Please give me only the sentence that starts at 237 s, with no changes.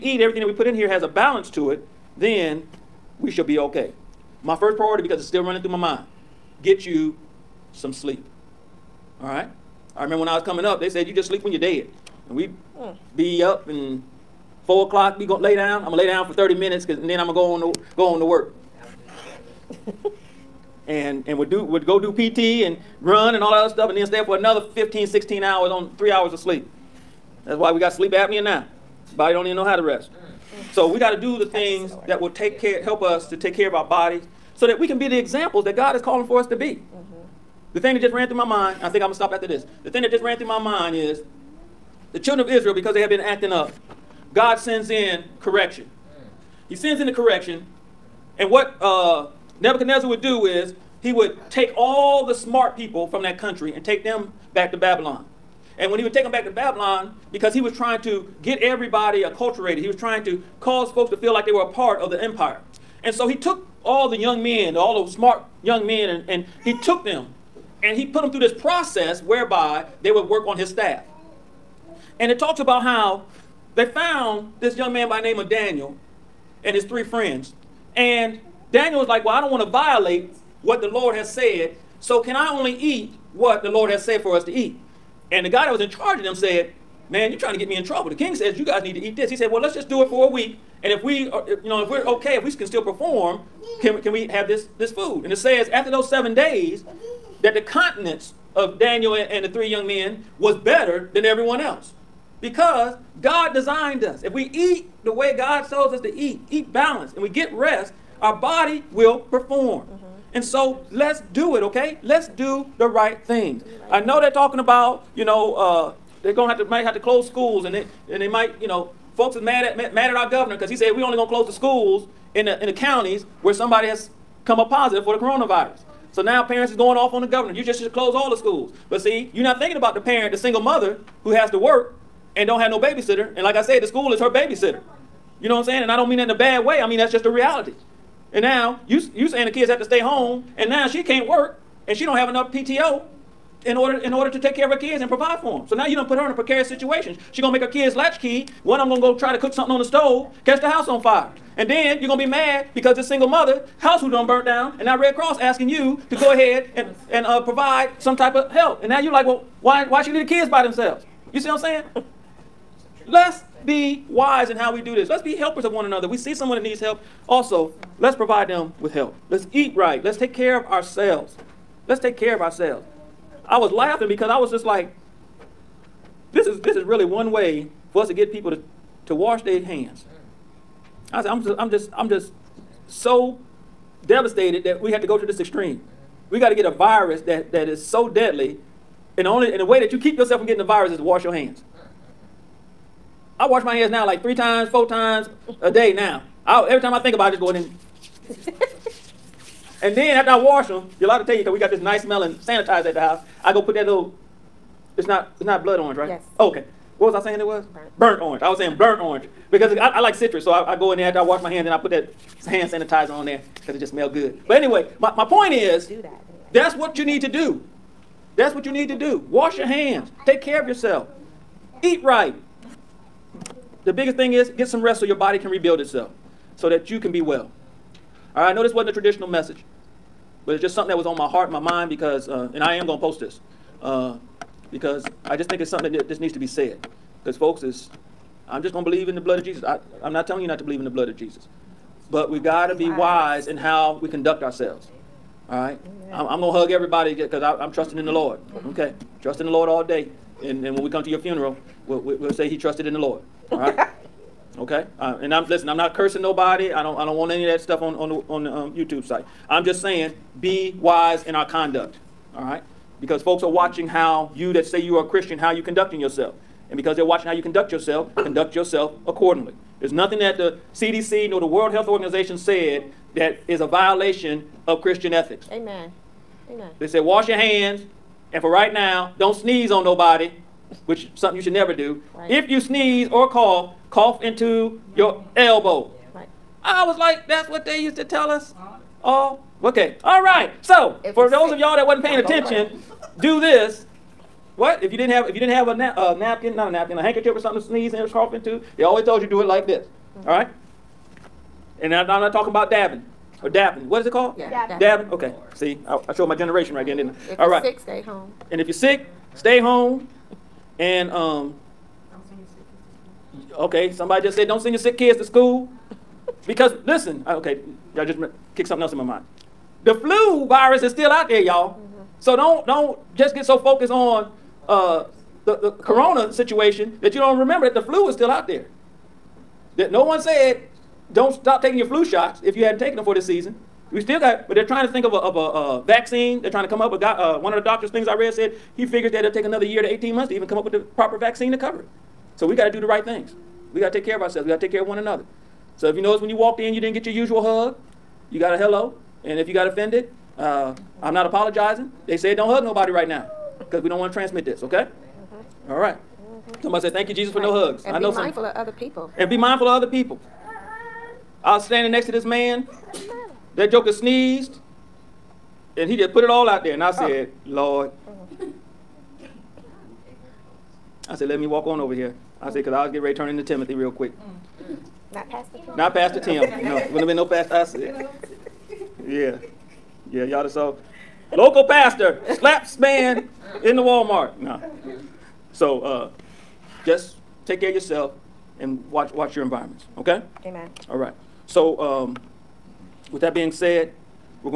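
Because, folks, is I'm just going to believe in the blood of Jesus.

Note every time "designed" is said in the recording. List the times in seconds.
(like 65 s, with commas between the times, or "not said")
103 s.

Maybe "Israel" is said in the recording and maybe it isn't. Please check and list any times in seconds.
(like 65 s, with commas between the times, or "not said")
42 s.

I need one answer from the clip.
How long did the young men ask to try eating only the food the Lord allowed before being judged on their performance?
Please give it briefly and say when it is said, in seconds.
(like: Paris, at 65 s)
A week, at 90 s.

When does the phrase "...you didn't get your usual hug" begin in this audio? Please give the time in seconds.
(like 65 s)
346 s.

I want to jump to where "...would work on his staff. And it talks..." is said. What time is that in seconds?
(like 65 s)
70 s.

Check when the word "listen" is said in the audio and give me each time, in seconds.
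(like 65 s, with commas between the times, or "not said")
255 s, 316 s.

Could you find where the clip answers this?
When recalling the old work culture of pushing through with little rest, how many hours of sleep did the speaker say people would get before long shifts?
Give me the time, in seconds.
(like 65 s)
25 s.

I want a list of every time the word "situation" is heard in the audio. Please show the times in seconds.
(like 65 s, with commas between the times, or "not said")
146 s, 326 s.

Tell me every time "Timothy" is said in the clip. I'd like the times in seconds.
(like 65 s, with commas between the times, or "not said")
373 s.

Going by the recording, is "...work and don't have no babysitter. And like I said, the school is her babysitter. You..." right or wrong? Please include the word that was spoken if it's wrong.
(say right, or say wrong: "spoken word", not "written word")
right.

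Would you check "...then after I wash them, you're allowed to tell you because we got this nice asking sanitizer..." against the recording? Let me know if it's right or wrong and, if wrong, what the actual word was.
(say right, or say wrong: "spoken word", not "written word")
wrong: "smelling", not "asking".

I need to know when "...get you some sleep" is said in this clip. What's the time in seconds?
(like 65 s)
6 s.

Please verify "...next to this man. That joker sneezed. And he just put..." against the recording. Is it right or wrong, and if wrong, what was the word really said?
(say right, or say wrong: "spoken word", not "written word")
right.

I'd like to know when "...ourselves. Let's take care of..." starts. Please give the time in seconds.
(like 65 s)
170 s.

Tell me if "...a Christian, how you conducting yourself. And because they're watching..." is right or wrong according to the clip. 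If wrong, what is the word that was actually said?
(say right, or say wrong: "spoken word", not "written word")
right.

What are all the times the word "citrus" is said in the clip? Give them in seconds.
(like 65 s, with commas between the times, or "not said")
210 s.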